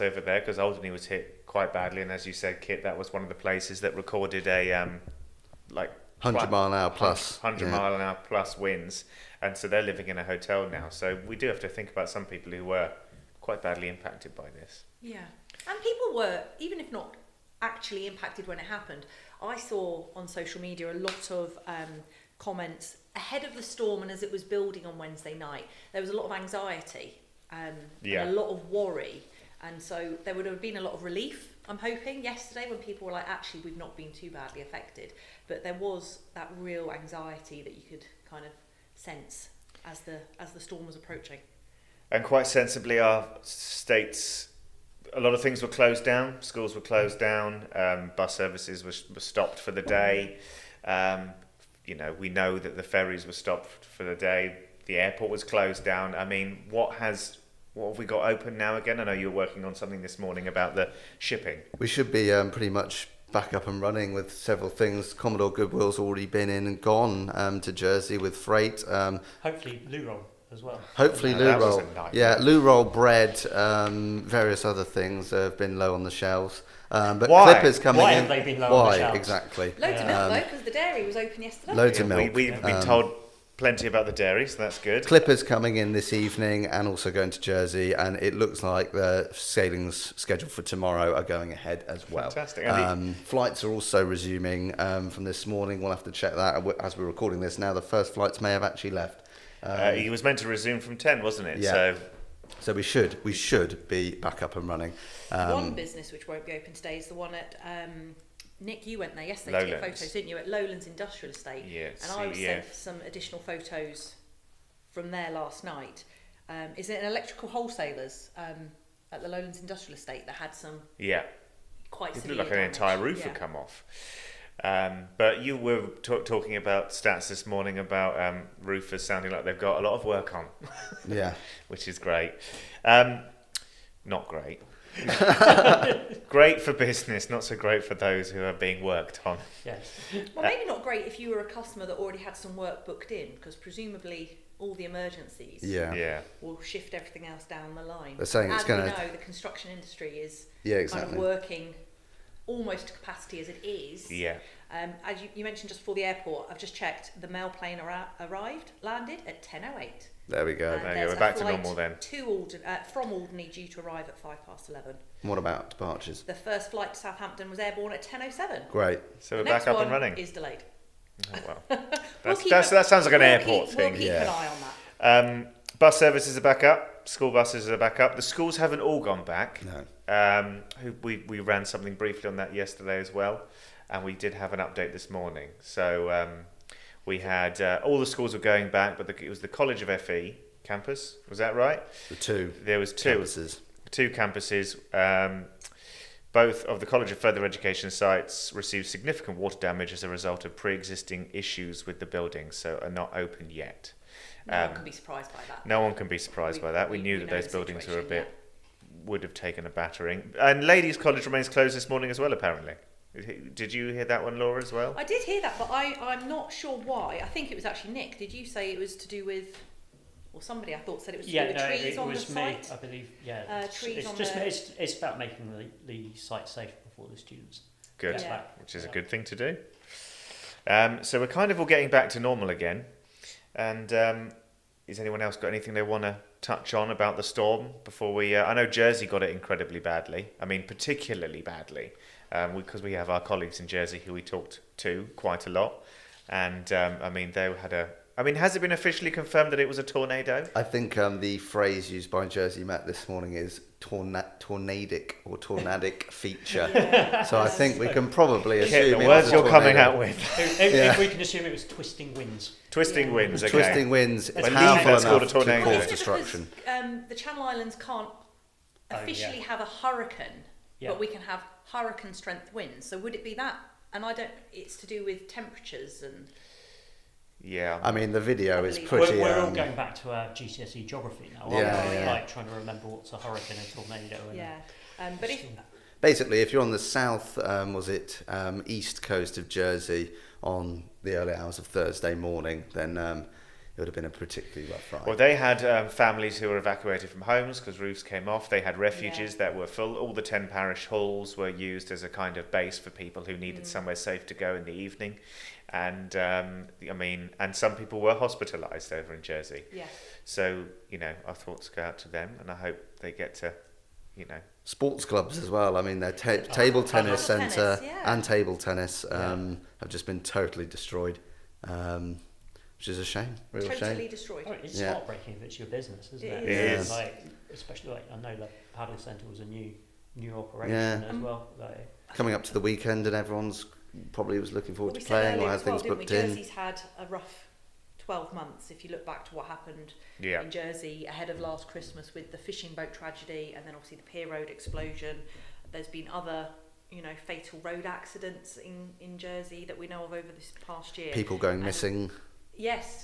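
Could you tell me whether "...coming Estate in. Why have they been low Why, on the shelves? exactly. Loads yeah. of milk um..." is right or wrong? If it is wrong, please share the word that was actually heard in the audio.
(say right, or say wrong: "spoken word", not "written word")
wrong: "Why", not "Estate".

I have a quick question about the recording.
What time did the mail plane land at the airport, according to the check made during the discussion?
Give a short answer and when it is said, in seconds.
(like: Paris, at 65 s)
10:08, at 159 s.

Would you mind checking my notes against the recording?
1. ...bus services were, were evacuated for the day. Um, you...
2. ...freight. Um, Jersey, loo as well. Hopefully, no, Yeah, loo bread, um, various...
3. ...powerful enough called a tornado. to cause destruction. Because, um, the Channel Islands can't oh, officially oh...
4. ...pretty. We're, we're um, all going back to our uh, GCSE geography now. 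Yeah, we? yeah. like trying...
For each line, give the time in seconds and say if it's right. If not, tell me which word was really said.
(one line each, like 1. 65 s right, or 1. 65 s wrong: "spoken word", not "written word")
1. 48 s wrong: "stopped", not "evacuated"
2. 68 s wrong: "Hopefully", not "Jersey"
3. 264 s right
4. 278 s right.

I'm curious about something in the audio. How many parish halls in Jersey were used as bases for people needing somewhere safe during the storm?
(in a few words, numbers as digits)
10.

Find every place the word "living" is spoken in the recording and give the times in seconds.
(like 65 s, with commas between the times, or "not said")
9 s.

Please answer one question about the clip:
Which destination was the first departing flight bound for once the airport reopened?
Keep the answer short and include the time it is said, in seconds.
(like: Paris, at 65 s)
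Southampton, at 166 s.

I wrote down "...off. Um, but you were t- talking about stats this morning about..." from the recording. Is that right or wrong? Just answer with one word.
right.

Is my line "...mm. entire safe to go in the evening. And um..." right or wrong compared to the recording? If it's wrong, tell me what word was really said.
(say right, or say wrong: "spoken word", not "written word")
wrong: "somewhere", not "entire".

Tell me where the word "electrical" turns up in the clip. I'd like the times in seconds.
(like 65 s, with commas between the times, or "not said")
117 s.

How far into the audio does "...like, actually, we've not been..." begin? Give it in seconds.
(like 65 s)
33 s.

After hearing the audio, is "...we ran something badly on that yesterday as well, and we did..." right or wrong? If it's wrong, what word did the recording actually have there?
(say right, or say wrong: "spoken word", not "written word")
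wrong: "briefly", not "badly".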